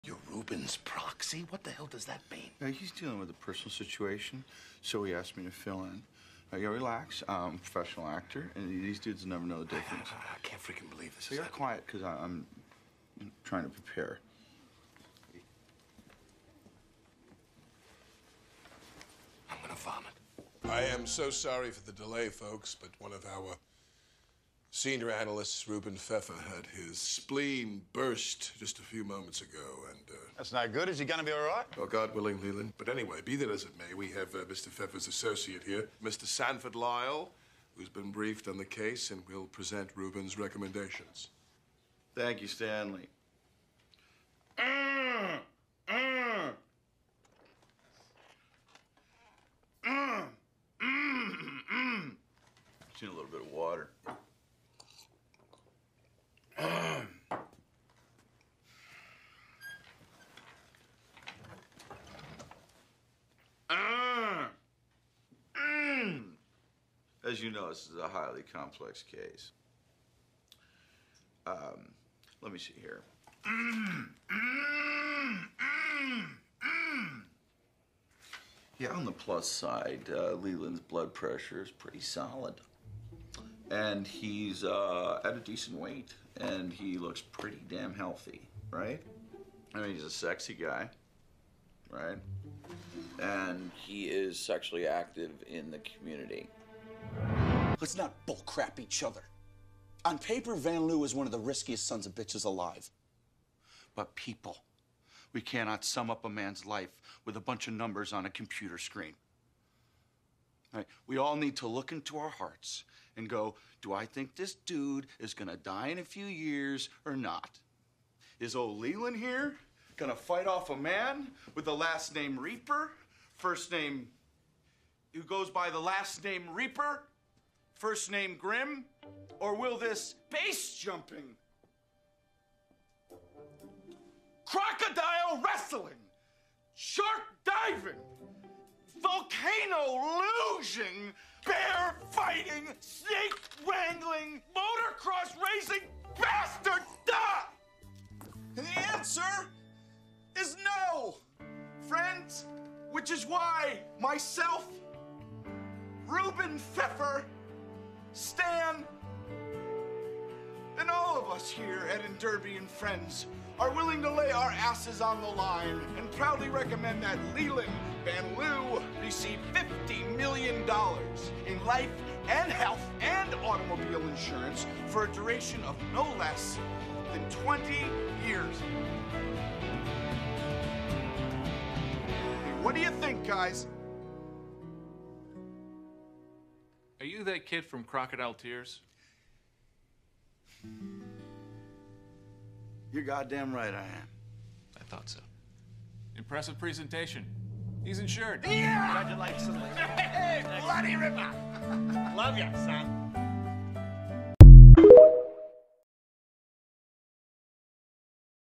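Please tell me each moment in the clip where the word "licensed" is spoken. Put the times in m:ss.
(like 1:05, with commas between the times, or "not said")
not said.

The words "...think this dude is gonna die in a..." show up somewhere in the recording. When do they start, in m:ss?
1:54.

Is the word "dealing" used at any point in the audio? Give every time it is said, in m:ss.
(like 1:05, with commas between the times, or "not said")
0:02.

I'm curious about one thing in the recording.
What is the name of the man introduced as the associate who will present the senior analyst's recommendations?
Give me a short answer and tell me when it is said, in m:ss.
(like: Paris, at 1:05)
Sanford Lyle, at 0:36.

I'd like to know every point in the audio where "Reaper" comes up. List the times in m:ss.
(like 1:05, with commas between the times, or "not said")
2:02, 2:06.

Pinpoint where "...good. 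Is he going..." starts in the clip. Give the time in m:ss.
0:30.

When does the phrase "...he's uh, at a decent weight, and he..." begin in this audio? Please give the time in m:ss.
1:24.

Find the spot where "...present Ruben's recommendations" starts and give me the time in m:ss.
0:39.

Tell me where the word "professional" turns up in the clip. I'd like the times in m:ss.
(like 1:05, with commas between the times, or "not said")
0:07.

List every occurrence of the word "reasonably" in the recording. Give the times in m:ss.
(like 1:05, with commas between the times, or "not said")
not said.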